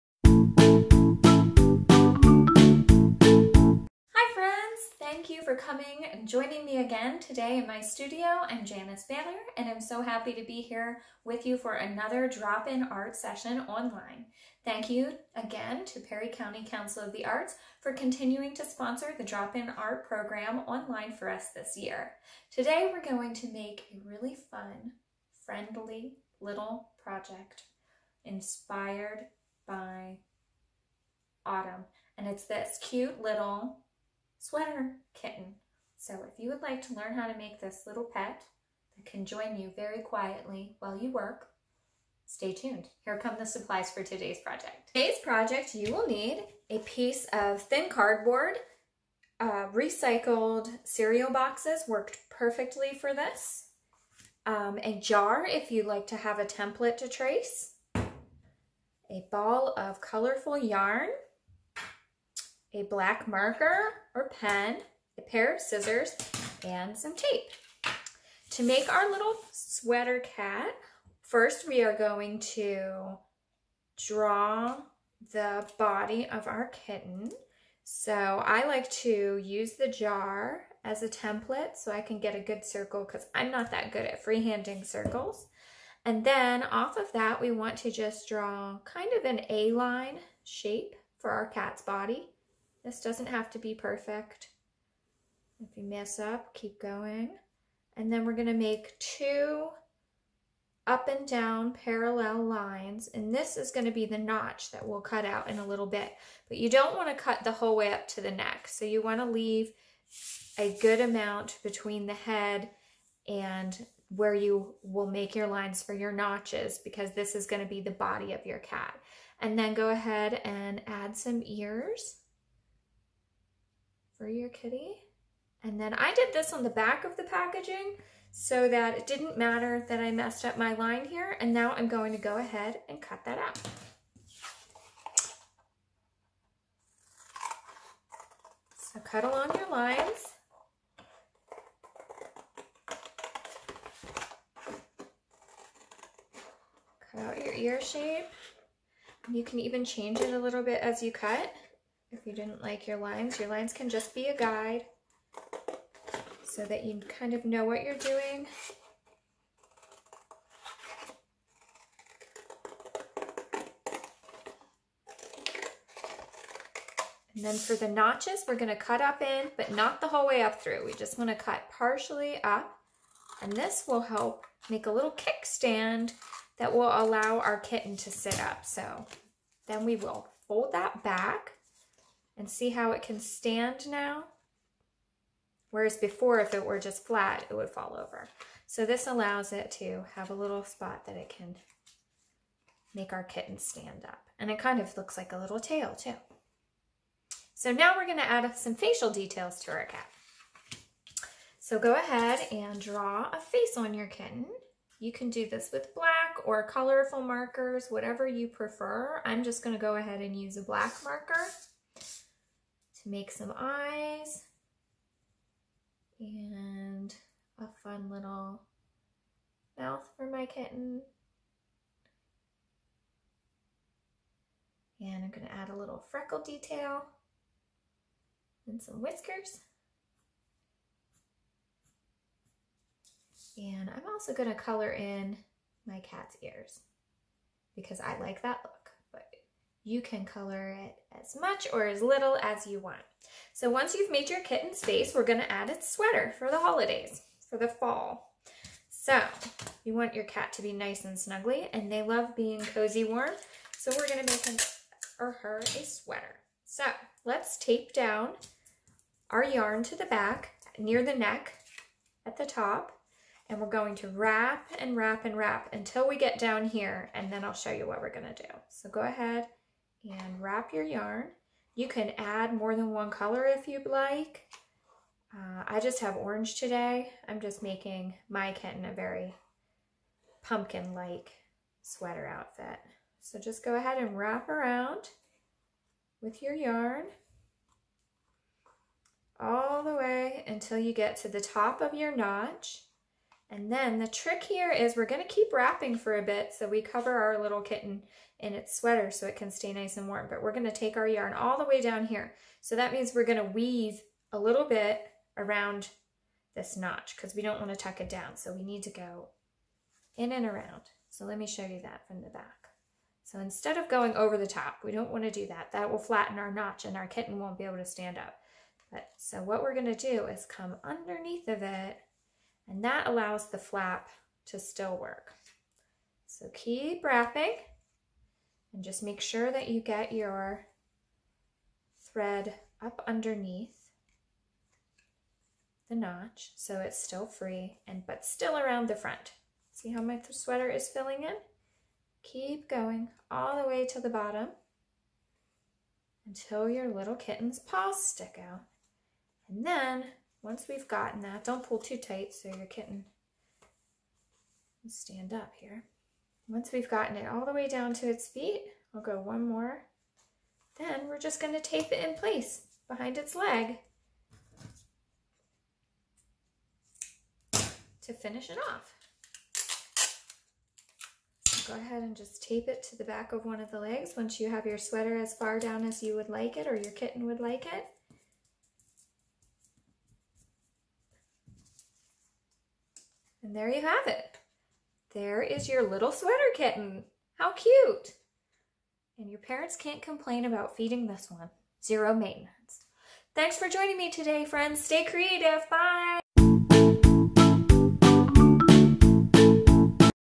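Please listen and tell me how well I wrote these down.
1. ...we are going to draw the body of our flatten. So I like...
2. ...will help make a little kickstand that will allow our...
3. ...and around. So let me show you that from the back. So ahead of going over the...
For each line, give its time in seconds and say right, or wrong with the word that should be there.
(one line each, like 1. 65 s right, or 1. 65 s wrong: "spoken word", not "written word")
1. 71 s wrong: "kitten", not "flatten"
2. 173 s right
3. 310 s wrong: "instead", not "ahead".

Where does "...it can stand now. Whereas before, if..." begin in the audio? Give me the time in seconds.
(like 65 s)
182 s.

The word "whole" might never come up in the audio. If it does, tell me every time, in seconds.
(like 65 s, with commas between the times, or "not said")
107 s, 170 s.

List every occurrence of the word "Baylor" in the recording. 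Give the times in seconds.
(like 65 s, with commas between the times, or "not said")
9 s.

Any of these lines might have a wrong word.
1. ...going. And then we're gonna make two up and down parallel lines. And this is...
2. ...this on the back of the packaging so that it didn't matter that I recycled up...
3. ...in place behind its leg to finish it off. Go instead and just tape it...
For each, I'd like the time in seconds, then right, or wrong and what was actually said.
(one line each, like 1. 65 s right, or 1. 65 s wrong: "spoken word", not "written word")
1. 96 s right
2. 126 s wrong: "messed", not "recycled"
3. 362 s wrong: "ahead", not "instead".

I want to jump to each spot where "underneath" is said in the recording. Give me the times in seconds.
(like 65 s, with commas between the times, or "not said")
320 s, 333 s.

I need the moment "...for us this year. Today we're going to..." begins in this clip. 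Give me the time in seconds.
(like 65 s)
21 s.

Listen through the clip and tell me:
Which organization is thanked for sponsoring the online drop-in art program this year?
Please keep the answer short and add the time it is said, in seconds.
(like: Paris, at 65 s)
Perry County Council of the Arts, at 15 s.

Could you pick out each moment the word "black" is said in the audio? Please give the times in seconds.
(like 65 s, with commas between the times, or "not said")
62 s, 205 s, 210 s.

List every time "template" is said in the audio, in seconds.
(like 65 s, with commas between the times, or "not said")
56 s, 81 s.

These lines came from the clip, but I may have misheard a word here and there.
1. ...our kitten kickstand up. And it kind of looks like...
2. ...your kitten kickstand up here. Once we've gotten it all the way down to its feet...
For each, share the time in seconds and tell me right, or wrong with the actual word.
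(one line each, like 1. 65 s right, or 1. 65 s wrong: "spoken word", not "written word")
1. 193 s wrong: "stand", not "kickstand"
2. 352 s wrong: "stand", not "kickstand".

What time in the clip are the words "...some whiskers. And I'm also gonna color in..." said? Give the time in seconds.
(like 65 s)
228 s.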